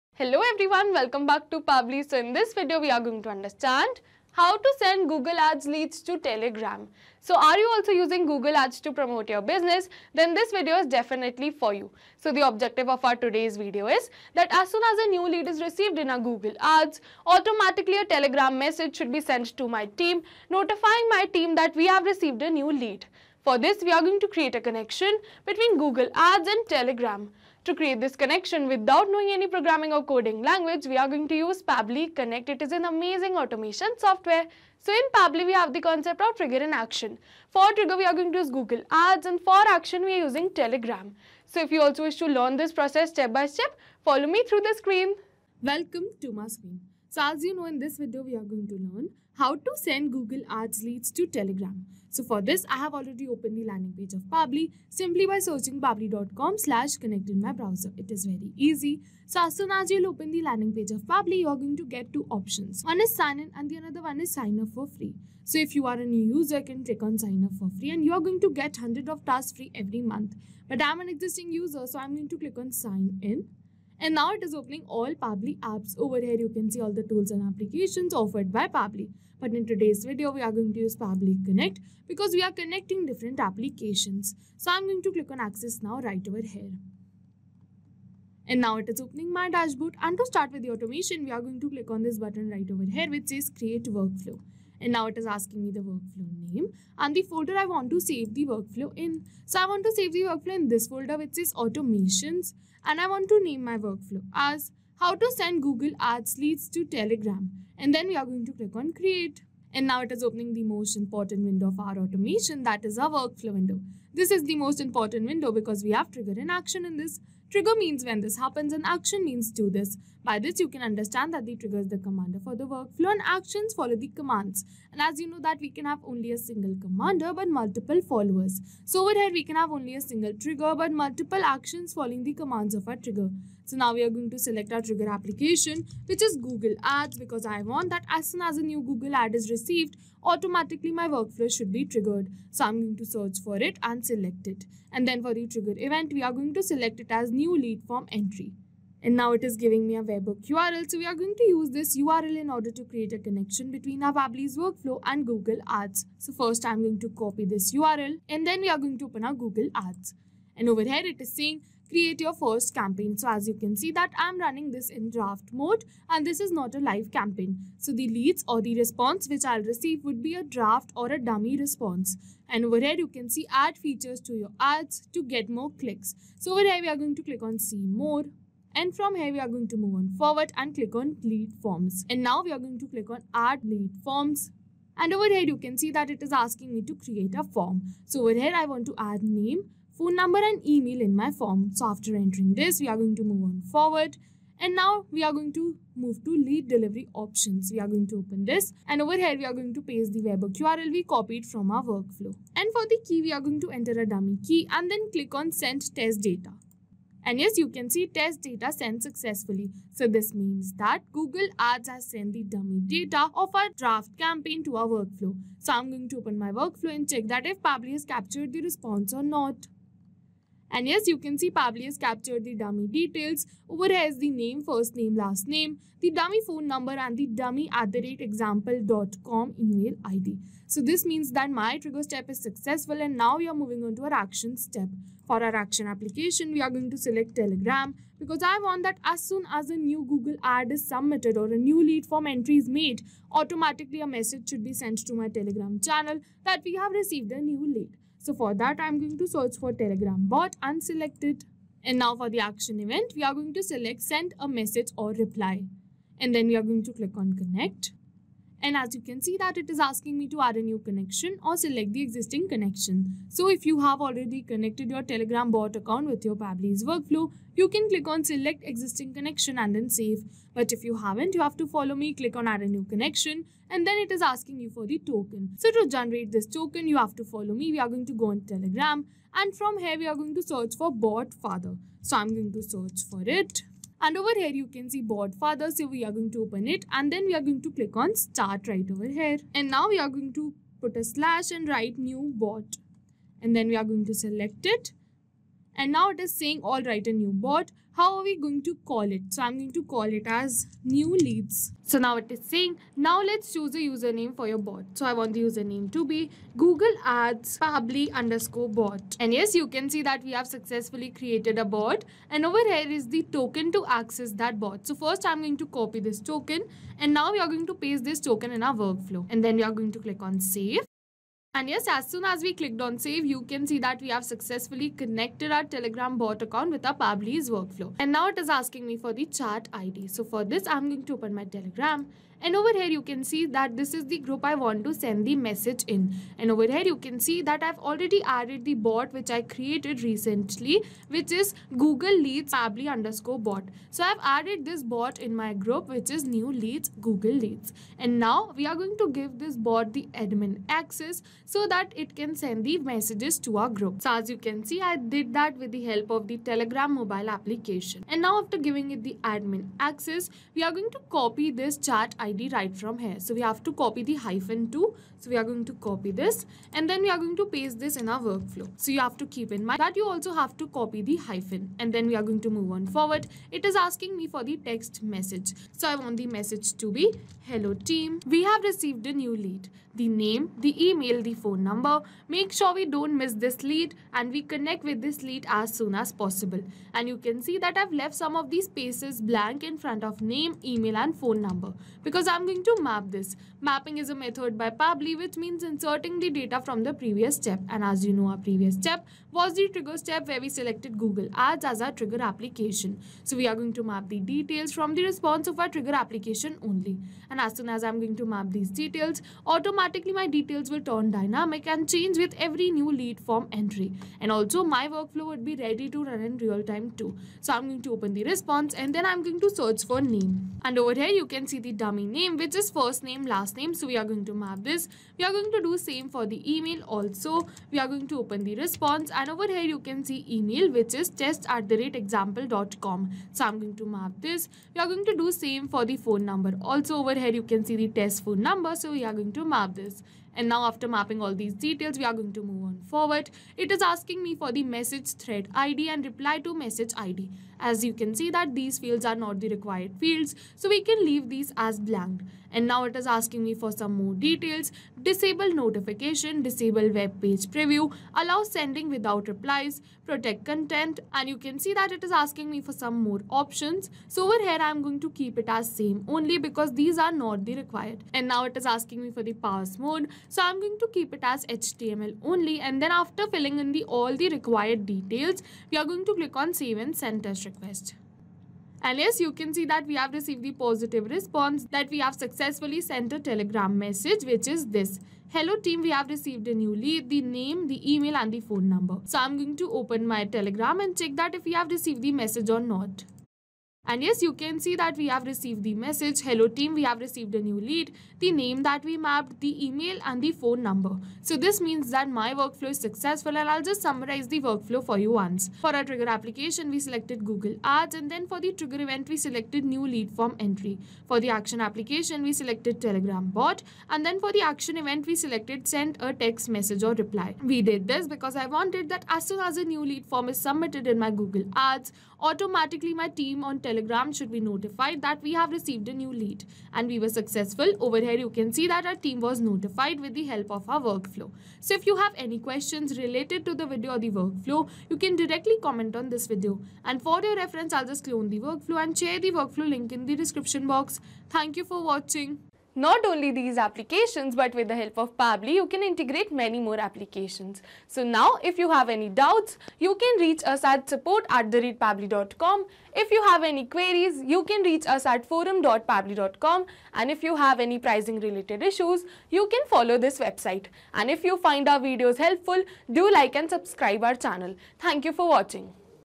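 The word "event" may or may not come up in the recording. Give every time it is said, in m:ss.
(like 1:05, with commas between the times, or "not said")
2:25, 4:12, 8:28, 8:34.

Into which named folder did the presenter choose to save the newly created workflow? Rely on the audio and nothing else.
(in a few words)
automations.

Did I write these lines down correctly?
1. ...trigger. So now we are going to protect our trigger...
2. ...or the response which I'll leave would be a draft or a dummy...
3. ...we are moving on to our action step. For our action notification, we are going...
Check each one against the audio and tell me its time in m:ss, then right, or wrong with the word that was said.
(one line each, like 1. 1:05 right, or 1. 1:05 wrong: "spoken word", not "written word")
1. 2:12 wrong: "select", not "protect"
2. 2:48 wrong: "receive", not "leave"
3. 3:53 wrong: "application", not "notification".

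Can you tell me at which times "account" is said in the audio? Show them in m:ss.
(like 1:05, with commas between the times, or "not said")
4:25, 5:26.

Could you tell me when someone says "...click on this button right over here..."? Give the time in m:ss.
1:31.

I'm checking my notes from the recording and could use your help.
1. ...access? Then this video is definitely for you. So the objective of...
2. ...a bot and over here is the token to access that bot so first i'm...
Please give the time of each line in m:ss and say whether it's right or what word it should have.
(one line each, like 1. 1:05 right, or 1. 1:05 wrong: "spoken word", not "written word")
1. 0:09 wrong: "business", not "access"
2. 5:11 right.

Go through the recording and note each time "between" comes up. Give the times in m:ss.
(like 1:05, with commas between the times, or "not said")
0:25, 2:33.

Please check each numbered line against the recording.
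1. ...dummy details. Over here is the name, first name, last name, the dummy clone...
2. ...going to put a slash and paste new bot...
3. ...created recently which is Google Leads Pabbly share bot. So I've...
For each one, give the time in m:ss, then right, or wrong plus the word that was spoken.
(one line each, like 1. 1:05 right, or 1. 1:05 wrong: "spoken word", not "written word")
1. 3:42 wrong: "phone", not "clone"
2. 4:50 wrong: "write", not "paste"
3. 5:39 wrong: "underscore", not "share".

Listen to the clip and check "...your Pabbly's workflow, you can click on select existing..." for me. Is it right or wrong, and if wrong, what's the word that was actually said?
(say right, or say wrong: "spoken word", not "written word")
right.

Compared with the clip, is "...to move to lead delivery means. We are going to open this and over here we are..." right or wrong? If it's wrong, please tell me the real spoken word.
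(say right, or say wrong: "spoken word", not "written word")
wrong: "options", not "means".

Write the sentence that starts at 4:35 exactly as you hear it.
So to generate this token, you have to follow me.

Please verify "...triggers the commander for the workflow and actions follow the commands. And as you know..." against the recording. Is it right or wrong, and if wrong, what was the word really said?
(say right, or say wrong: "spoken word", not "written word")
right.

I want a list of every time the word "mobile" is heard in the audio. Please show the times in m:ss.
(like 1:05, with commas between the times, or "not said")
5:56.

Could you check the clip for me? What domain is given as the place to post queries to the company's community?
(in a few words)
forum.pabbly.com.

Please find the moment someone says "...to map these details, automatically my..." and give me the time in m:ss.
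6:48.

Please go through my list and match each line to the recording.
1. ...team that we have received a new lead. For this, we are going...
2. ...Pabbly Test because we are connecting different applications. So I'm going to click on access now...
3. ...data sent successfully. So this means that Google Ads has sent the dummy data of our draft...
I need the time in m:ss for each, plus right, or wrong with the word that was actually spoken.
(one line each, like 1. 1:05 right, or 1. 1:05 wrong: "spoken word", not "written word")
1. 0:21 right
2. 1:20 wrong: "Connect", not "Test"
3. 3:28 right.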